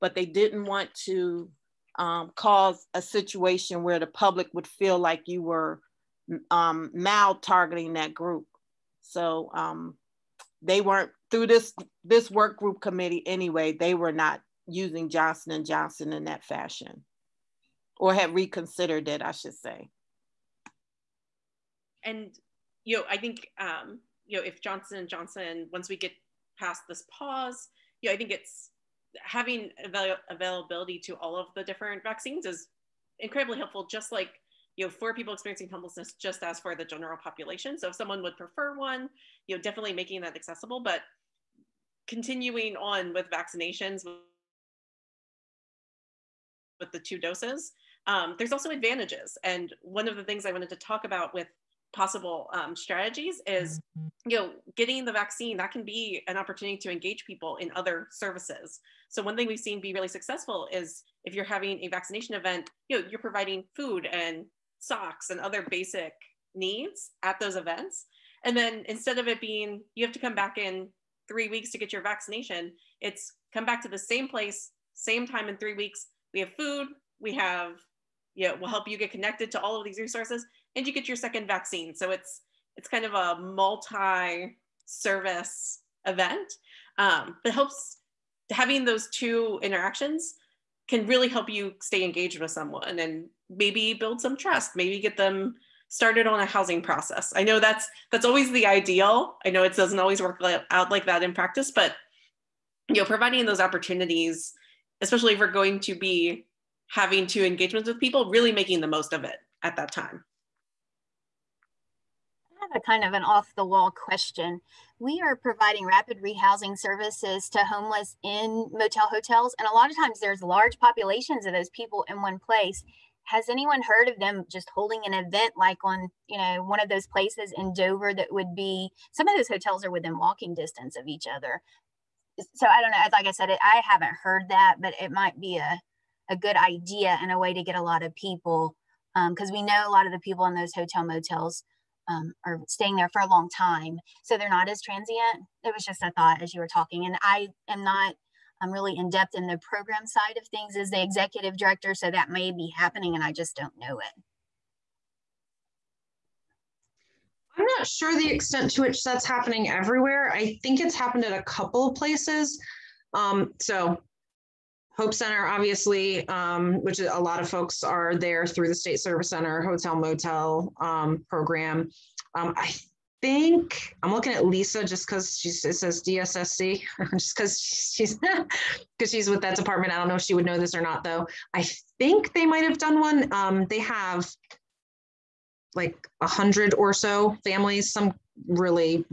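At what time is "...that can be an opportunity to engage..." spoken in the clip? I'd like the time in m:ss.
0:55.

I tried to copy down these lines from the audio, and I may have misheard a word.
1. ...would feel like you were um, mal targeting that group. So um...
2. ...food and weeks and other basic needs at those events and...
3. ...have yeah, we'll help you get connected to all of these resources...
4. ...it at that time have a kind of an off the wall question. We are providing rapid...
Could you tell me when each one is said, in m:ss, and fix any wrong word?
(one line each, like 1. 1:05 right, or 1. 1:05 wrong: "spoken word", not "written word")
1. 0:04 right
2. 1:03 wrong: "socks", not "weeks"
3. 1:17 right
4. 1:49 right.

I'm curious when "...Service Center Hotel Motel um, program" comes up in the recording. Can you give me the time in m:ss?
2:48.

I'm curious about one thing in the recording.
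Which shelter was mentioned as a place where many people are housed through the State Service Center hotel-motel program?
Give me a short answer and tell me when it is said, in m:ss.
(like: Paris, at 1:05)
Hope Center, at 2:44.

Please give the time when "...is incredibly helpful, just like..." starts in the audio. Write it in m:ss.
0:32.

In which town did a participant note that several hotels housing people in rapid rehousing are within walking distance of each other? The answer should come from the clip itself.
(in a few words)
Dover.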